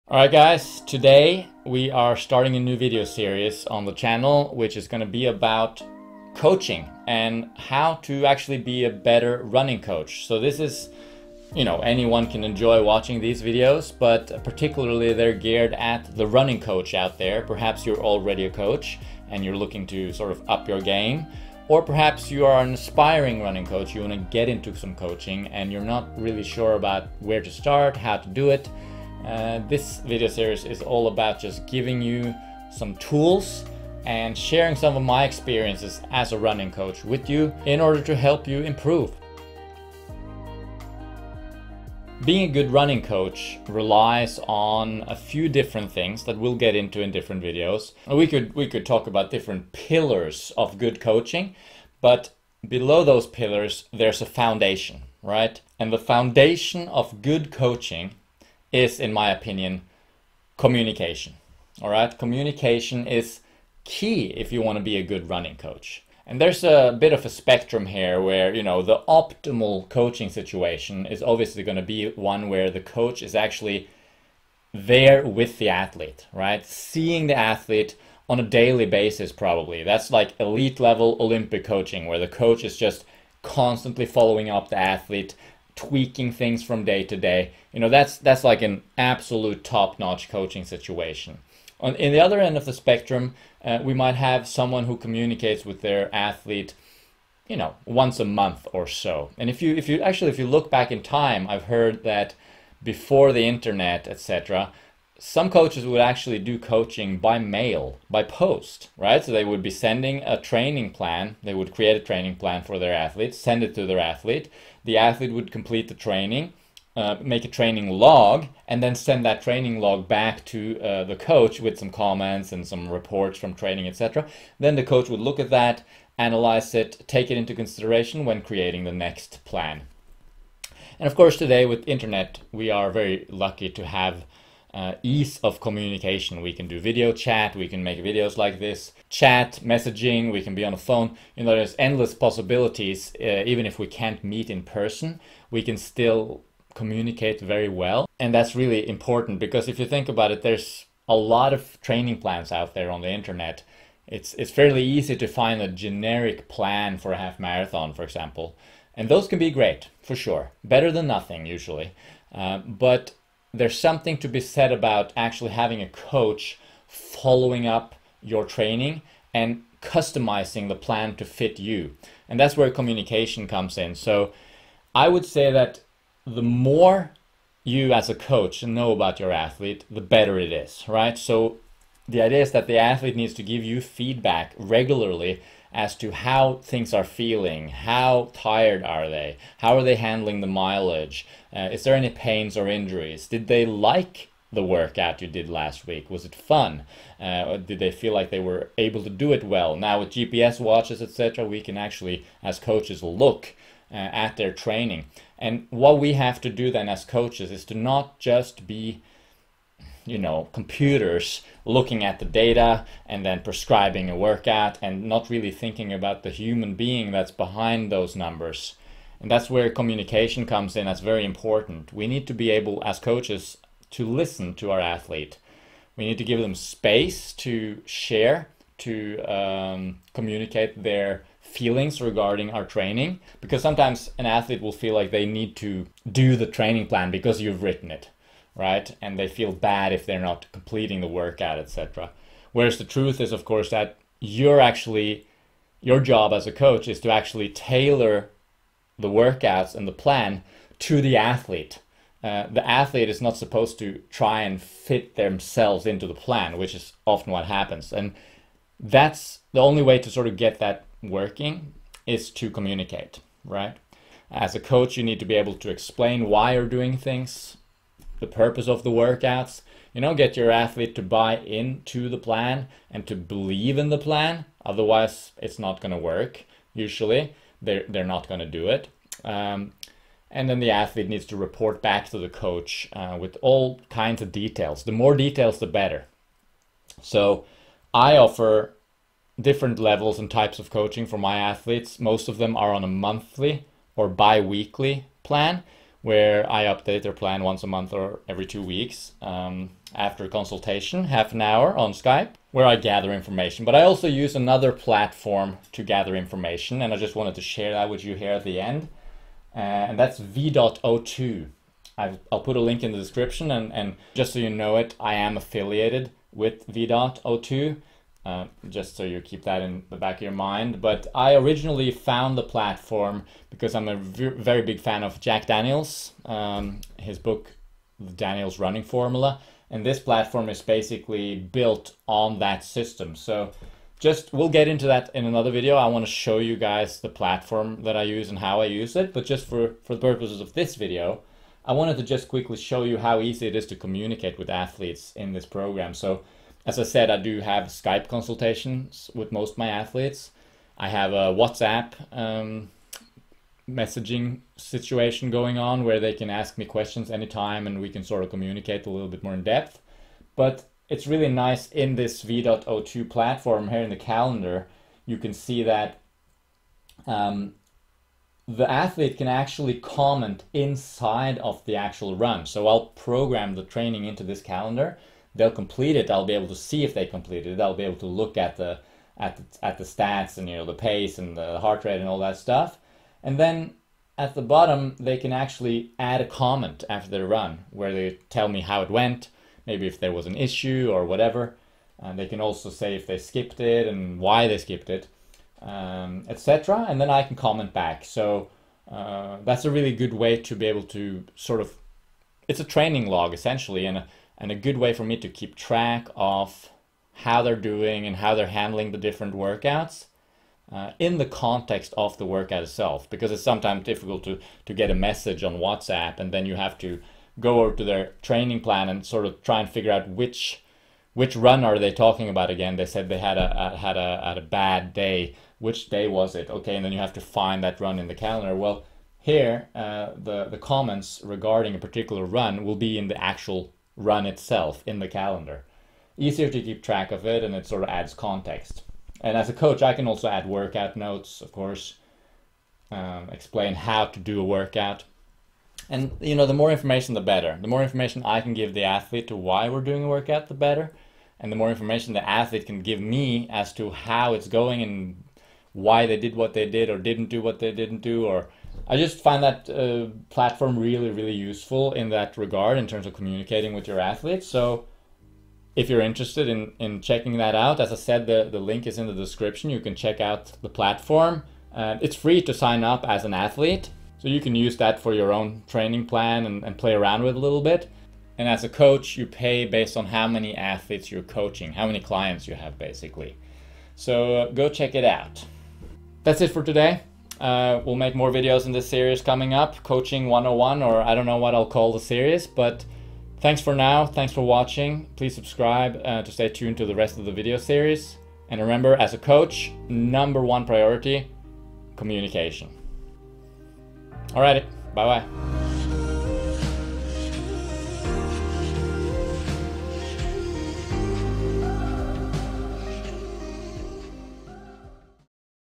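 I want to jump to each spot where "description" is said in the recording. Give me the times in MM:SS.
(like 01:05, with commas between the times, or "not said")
05:12, 07:49.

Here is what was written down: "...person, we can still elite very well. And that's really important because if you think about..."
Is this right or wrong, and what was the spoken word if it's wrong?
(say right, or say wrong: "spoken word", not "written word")
wrong: "communicate", not "elite".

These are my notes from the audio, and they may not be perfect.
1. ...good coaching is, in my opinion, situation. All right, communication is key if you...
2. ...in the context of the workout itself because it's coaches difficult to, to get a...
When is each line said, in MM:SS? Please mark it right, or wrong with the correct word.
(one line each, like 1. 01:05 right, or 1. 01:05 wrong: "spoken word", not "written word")
1. 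00:57 wrong: "communication", not "situation"
2. 06:50 wrong: "sometimes", not "coaches".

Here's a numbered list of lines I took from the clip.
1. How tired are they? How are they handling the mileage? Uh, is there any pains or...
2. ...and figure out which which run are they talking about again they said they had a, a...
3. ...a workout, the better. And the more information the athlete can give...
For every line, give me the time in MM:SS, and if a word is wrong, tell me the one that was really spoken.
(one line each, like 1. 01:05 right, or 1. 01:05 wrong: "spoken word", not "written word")
1. 03:07 right
2. 06:59 right
3. 07:30 right.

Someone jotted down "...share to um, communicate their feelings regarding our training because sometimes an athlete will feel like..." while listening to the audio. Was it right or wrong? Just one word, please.
right.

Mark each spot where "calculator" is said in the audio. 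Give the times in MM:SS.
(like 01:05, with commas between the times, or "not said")
not said.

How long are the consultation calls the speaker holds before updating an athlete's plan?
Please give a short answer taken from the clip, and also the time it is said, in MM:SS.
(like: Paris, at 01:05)
Half an hour, at 05:01.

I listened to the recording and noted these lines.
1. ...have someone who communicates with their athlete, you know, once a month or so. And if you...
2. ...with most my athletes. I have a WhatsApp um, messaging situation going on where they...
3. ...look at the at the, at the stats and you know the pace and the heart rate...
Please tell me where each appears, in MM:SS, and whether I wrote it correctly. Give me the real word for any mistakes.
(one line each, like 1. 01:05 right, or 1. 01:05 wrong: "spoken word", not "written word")
1. 01:34 right
2. 05:49 right
3. 06:18 right.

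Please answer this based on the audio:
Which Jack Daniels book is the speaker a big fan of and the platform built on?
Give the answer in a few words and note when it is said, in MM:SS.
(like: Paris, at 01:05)
The Daniels Running Formula, at 05:27.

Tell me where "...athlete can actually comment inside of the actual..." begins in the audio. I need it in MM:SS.
06:08.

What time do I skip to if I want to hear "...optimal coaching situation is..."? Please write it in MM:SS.
01:09.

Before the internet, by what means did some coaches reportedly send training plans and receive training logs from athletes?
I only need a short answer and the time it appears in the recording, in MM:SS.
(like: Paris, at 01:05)
By mail, at 01:47.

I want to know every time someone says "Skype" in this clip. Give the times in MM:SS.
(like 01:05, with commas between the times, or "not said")
05:01, 05:47.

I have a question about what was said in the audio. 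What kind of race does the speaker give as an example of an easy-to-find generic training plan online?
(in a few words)
Half marathon.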